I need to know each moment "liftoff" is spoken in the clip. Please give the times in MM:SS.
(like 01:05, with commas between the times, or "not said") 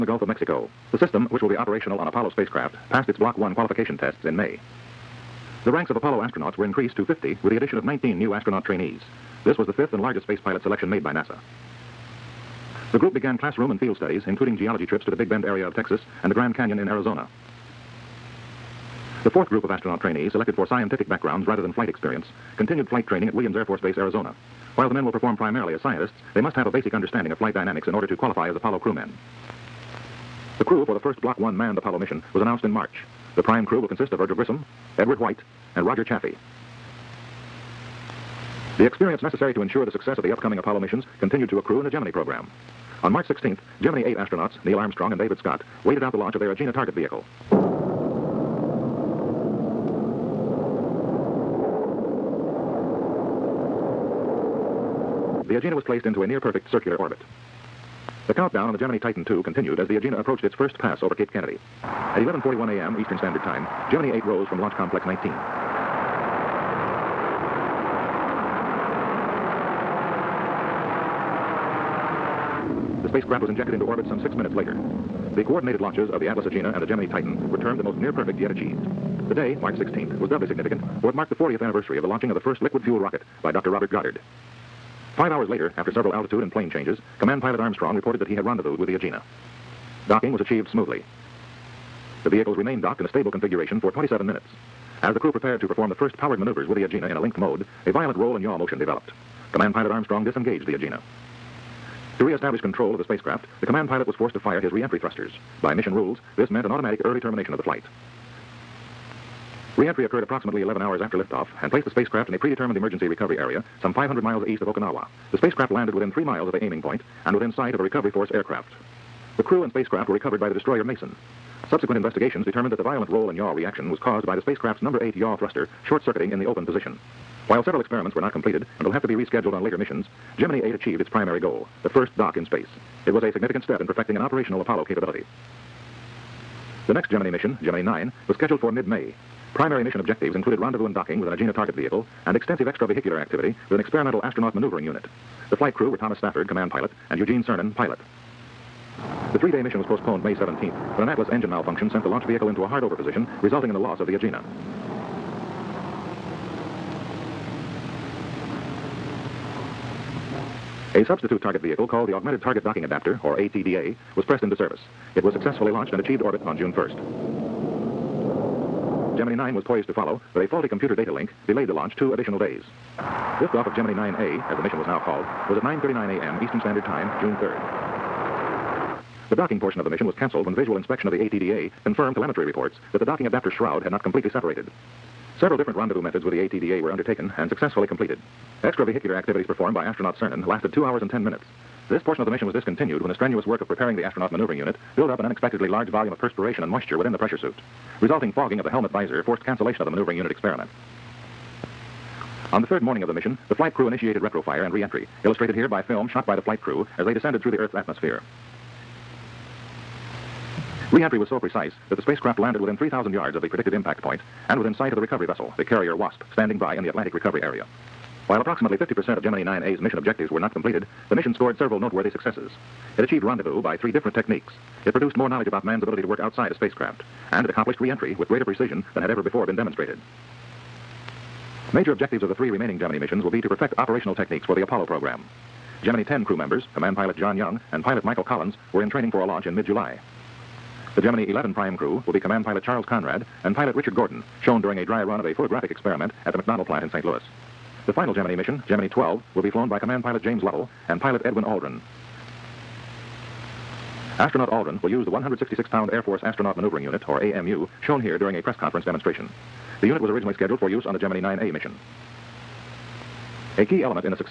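01:51, 02:52.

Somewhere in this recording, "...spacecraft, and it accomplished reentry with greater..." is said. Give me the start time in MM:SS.
03:46.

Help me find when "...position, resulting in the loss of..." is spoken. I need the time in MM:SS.
02:32.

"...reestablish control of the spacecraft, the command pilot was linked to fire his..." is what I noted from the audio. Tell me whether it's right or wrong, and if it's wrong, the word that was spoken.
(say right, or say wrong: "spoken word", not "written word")
wrong: "forced", not "linked".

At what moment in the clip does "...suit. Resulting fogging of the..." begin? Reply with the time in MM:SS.
03:17.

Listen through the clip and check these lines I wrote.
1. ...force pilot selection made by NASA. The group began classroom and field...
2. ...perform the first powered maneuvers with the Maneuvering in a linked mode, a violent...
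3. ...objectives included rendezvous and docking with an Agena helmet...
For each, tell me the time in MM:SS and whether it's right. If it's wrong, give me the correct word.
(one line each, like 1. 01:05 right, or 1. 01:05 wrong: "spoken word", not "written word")
1. 00:10 wrong: "space", not "force"
2. 01:35 wrong: "Agena", not "Maneuvering"
3. 02:19 wrong: "target", not "helmet".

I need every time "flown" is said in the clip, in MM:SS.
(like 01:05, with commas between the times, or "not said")
04:09.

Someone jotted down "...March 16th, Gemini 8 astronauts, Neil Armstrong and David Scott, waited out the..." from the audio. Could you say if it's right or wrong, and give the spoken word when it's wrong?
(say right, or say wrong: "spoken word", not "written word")
right.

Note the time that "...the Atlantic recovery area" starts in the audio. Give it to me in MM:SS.
03:36.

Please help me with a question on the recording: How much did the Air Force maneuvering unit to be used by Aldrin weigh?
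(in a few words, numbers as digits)
166 pounds.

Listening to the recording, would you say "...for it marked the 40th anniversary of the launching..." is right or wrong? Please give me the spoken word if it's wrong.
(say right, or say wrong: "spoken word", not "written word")
right.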